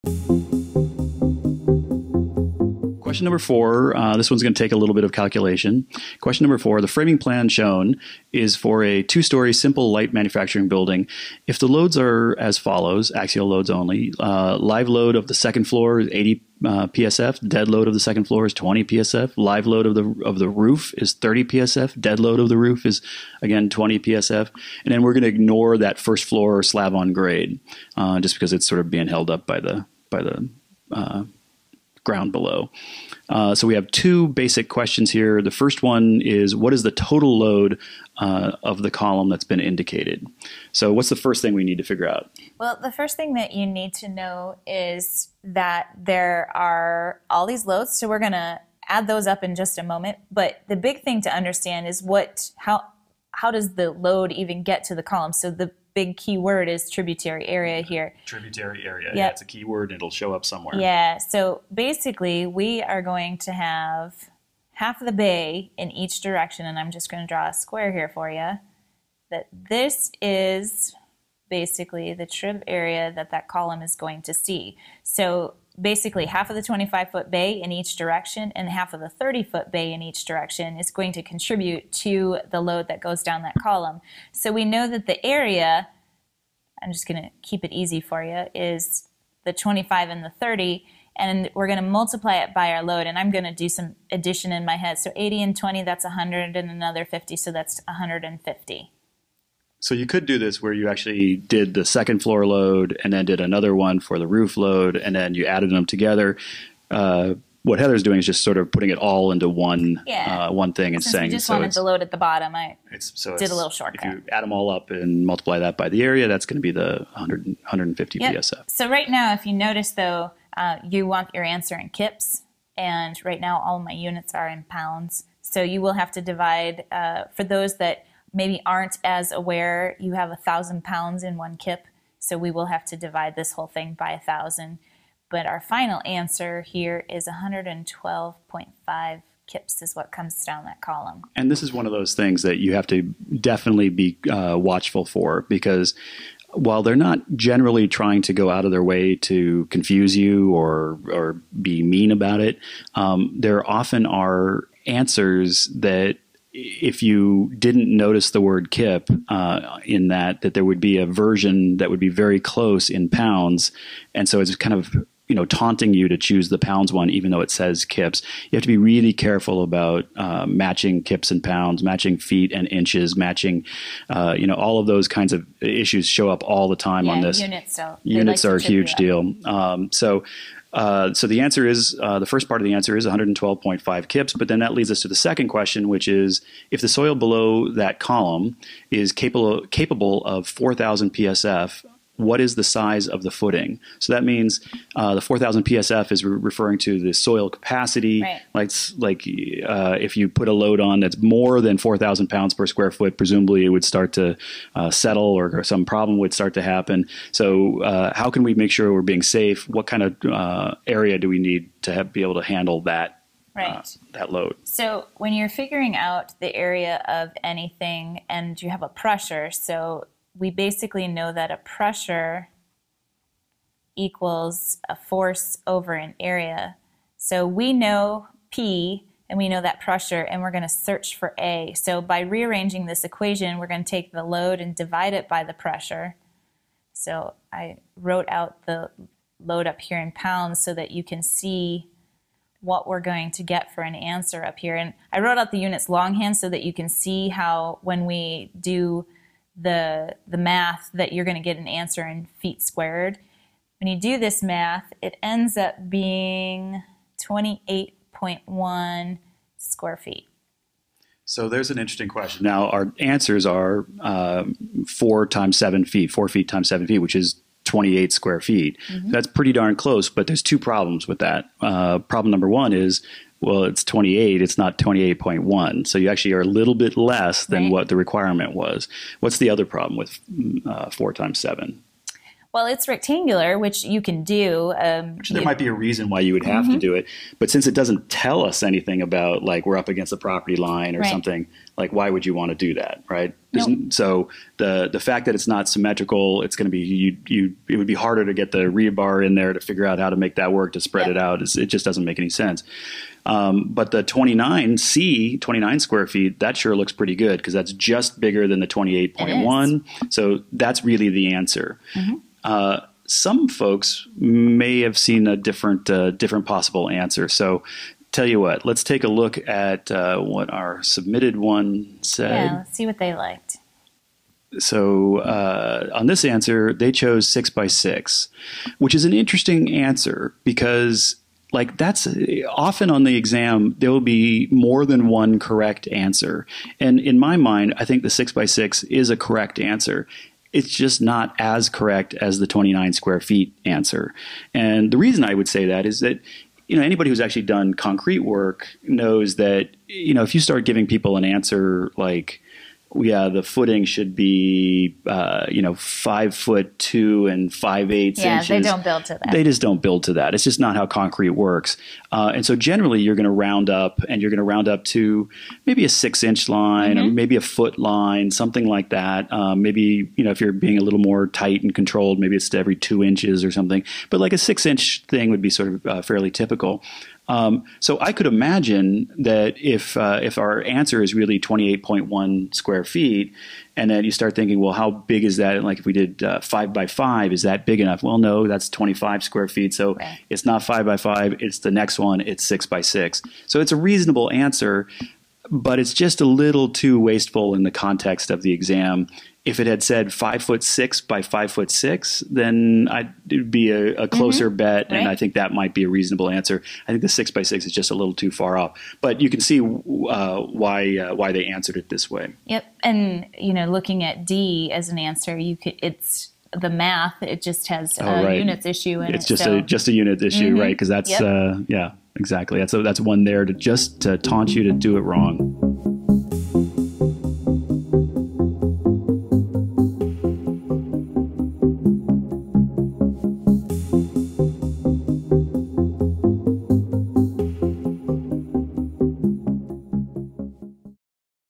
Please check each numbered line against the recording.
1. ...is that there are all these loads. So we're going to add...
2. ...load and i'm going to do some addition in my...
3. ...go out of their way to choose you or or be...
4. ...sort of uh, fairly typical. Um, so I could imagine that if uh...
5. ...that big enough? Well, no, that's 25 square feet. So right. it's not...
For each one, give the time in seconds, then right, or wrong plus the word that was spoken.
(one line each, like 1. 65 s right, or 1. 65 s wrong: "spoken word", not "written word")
1. 44 s right
2. 92 s right
3. 148 s wrong: "confuse", not "choose"
4. 375 s right
5. 387 s right.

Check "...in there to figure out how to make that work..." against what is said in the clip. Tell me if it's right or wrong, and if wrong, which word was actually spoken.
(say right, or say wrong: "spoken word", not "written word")
right.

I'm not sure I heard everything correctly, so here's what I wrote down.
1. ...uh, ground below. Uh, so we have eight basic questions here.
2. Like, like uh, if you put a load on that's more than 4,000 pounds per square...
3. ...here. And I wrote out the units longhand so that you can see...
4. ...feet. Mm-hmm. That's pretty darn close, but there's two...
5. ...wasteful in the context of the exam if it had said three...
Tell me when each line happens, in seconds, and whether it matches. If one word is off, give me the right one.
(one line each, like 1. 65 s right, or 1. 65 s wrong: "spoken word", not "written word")
1. 30 s wrong: "two", not "eight"
2. 198 s right
3. 244 s right
4. 268 s right
5. 396 s wrong: "five", not "three".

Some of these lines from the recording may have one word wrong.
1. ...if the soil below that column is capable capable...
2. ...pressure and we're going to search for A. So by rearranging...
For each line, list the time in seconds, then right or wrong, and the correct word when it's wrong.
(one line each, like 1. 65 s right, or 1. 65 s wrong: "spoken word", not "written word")
1. 186 s right
2. 229 s right.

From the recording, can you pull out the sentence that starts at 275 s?
So you actually are a little bit less than right.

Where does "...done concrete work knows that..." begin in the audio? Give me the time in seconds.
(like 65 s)
347 s.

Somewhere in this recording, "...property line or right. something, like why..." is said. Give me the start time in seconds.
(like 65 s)
290 s.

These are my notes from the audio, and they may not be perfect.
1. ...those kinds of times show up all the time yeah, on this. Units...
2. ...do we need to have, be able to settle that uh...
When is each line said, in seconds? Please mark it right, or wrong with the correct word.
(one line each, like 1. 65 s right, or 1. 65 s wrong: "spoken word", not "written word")
1. 174 s wrong: "issues", not "times"
2. 211 s wrong: "handle", not "settle".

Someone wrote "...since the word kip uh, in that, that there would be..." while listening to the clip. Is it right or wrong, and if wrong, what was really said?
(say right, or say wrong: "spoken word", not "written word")
wrong: "notice", not "since".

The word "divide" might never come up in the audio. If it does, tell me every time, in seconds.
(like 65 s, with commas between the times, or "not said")
126 s, 132 s, 234 s.